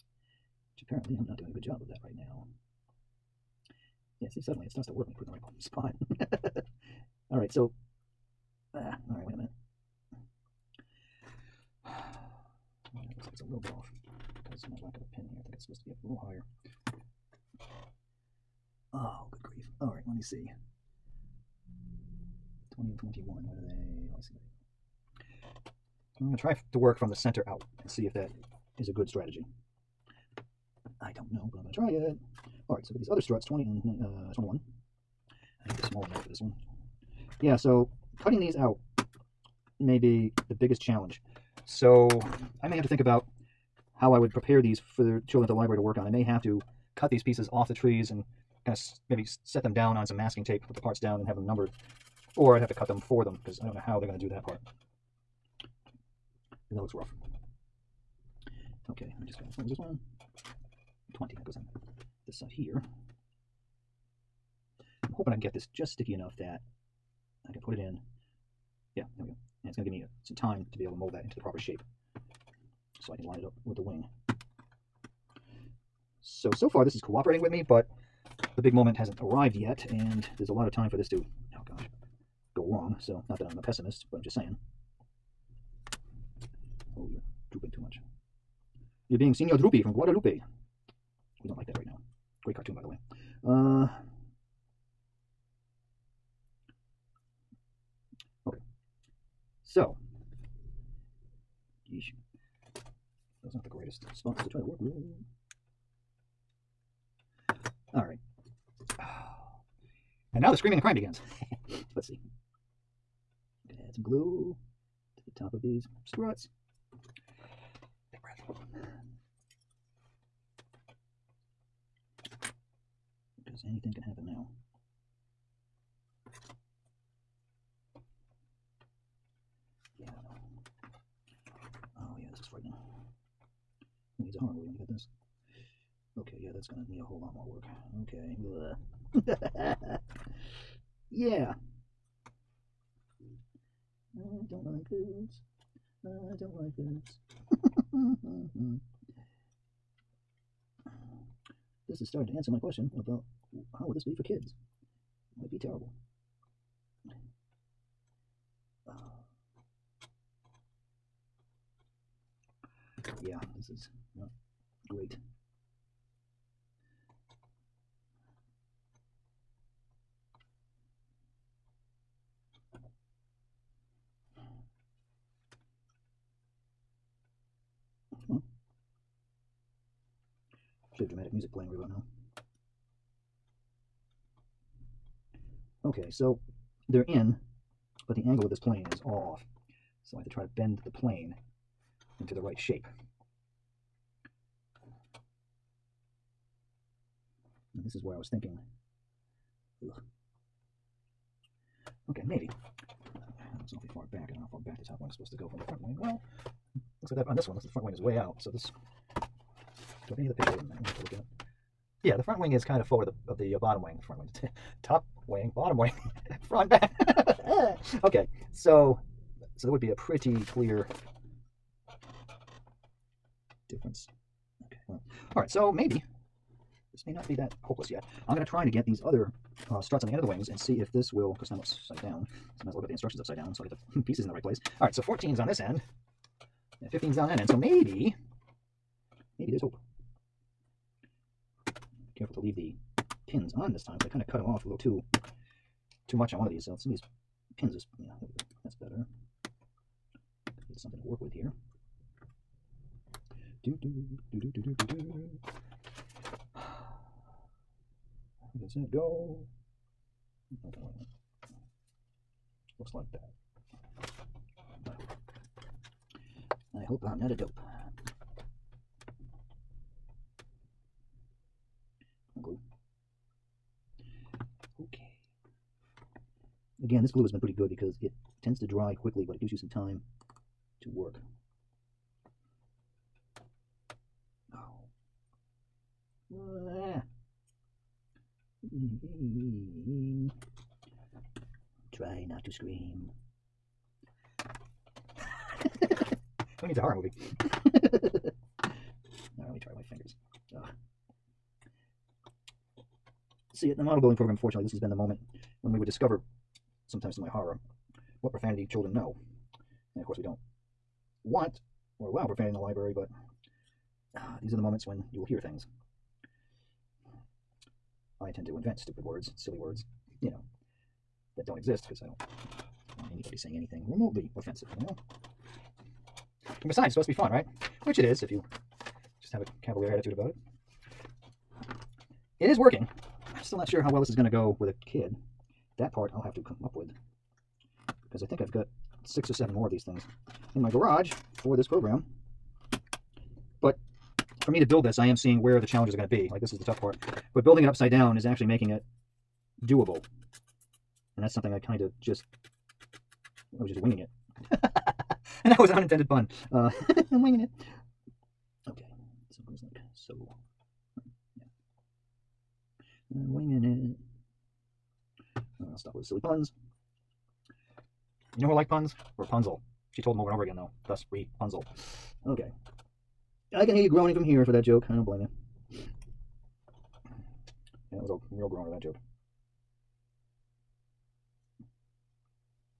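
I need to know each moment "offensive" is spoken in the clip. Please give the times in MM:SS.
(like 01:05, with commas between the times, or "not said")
05:24.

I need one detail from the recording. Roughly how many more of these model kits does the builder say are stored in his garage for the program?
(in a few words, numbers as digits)
6 or 7.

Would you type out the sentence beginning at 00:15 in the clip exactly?
I think it's supposed to be up a little higher.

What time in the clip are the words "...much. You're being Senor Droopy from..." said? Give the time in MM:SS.
01:27.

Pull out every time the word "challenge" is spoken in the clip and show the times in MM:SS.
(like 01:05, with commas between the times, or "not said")
00:40, 05:45.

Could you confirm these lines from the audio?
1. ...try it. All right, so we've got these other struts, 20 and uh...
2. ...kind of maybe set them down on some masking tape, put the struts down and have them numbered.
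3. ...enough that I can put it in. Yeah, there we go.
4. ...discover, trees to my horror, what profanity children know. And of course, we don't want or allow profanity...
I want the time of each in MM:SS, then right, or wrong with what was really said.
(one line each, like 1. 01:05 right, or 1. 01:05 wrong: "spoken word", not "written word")
1. 00:31 right
2. 00:48 wrong: "parts", not "struts"
3. 01:06 right
4. 05:05 wrong: "sometimes", not "trees".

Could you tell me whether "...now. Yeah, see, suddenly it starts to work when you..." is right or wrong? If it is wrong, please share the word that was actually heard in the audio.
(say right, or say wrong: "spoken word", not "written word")
right.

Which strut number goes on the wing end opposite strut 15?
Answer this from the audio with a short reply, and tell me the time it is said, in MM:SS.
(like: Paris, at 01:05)
14, at 03:55.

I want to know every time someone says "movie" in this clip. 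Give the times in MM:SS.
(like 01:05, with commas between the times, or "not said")
02:14, 04:56.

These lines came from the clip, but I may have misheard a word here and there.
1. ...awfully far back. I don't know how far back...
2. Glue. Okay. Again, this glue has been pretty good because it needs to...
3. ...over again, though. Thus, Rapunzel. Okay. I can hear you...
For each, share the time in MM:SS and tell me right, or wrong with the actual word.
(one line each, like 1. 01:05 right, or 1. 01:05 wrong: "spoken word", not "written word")
1. 03:23 right
2. 04:32 wrong: "tends", not "needs"
3. 06:10 right.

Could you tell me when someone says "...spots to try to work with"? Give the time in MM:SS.
01:44.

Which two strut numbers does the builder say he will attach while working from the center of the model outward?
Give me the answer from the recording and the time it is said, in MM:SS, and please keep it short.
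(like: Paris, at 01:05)
20 and 21, at 00:22.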